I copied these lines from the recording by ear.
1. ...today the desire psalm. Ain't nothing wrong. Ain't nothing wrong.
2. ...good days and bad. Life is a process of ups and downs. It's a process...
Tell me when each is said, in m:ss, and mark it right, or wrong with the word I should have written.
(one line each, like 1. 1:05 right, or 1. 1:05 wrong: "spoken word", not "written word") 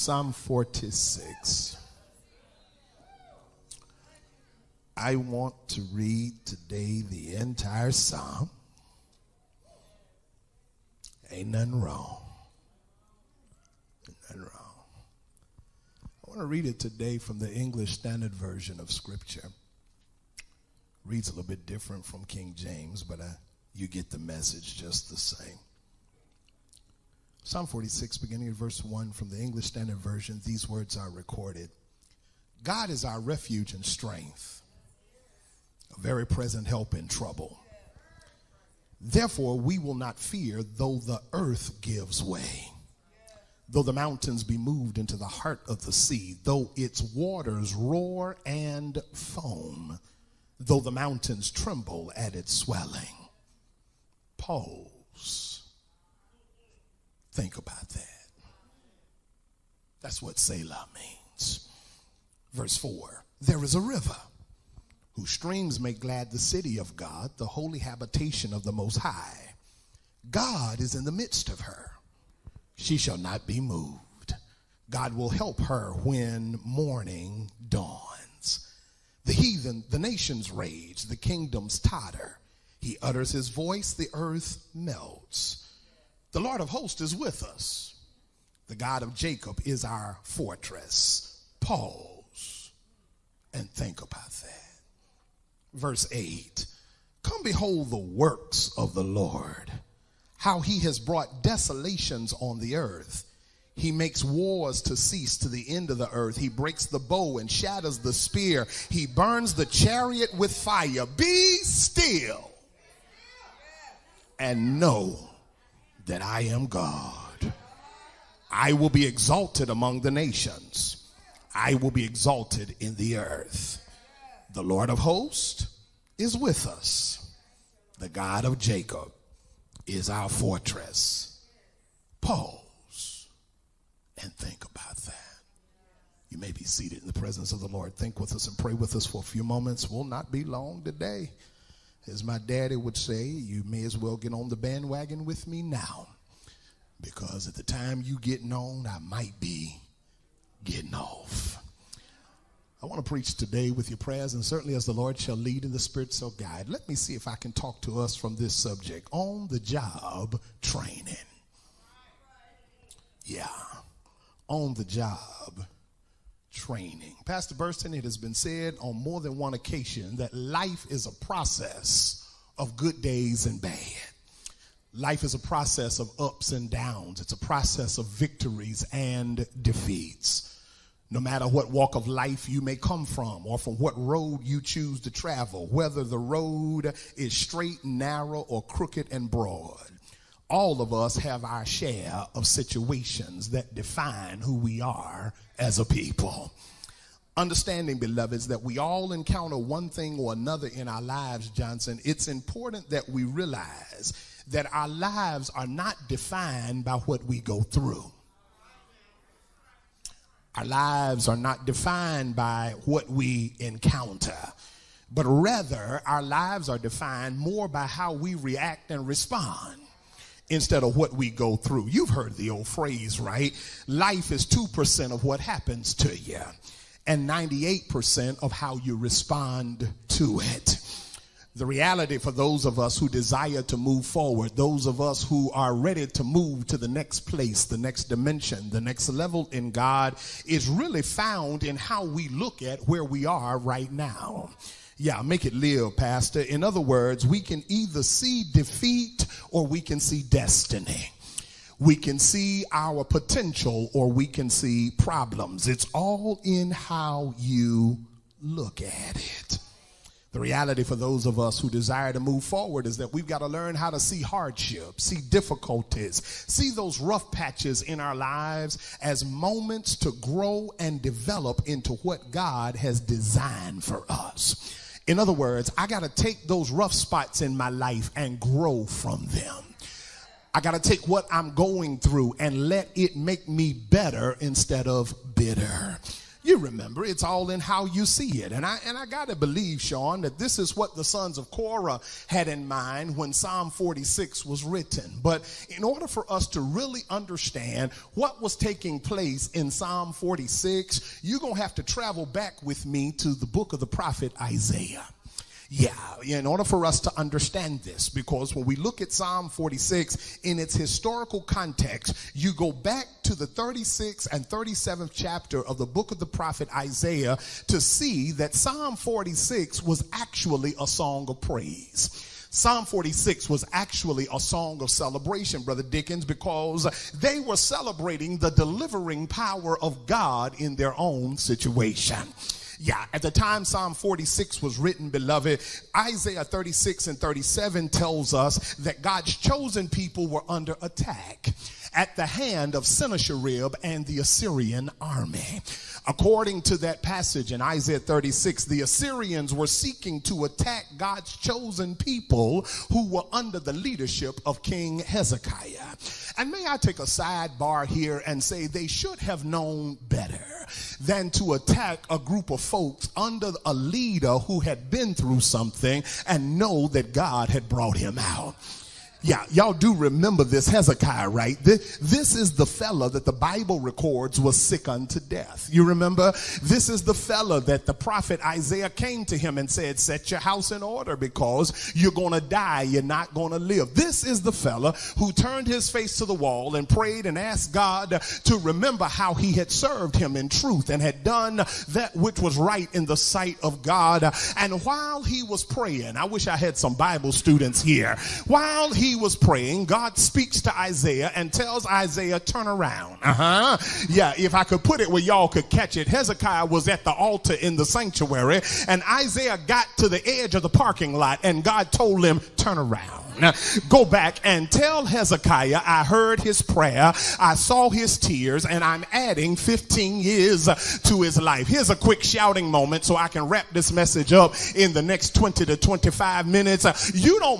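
1. 0:06 wrong: "entire", not "desire"
2. 2:52 right.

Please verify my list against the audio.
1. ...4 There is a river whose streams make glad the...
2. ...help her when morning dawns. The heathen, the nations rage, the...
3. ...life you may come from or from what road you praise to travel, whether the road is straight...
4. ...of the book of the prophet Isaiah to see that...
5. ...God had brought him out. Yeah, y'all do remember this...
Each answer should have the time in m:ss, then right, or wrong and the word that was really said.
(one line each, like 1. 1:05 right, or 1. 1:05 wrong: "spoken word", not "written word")
1. 1:02 right
2. 1:15 right
3. 3:02 wrong: "choose", not "praise"
4. 5:15 right
5. 6:07 right.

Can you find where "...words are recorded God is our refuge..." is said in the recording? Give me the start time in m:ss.
0:30.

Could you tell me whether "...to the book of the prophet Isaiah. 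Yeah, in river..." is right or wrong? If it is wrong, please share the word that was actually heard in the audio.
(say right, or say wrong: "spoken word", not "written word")
wrong: "order", not "river".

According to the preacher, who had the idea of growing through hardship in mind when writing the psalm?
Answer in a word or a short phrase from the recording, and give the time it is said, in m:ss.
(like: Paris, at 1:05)
The sons of Korah, at 4:51.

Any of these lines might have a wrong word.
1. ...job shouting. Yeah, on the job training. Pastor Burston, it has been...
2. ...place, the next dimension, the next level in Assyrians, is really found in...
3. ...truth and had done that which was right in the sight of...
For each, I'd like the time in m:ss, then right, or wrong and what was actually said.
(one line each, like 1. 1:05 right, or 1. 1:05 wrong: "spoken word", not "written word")
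1. 2:39 wrong: "training", not "shouting"
2. 3:57 wrong: "God", not "Assyrians"
3. 6:30 right.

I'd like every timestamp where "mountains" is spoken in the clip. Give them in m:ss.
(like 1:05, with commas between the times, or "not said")
0:43, 0:50.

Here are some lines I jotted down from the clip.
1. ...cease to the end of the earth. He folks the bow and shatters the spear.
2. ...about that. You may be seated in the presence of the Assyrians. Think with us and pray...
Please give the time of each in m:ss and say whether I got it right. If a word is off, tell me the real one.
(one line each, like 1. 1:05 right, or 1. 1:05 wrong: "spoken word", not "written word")
1. 1:44 wrong: "breaks", not "folks"
2. 2:14 wrong: "Lord", not "Assyrians".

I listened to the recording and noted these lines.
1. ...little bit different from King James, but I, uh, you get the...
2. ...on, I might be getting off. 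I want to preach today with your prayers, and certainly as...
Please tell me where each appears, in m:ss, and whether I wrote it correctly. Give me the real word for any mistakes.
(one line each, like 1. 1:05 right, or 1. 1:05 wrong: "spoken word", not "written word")
1. 0:21 right
2. 2:28 right.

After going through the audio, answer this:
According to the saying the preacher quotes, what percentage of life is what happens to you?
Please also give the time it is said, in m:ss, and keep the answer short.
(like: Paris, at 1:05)
2%, at 3:44.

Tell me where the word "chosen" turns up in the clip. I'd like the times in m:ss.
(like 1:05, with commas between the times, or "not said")
5:39, 5:51.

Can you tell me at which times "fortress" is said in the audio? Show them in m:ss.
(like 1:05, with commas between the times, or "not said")
1:30, 2:10.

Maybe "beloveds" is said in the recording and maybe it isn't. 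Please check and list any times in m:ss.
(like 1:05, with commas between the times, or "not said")
3:17, 5:35.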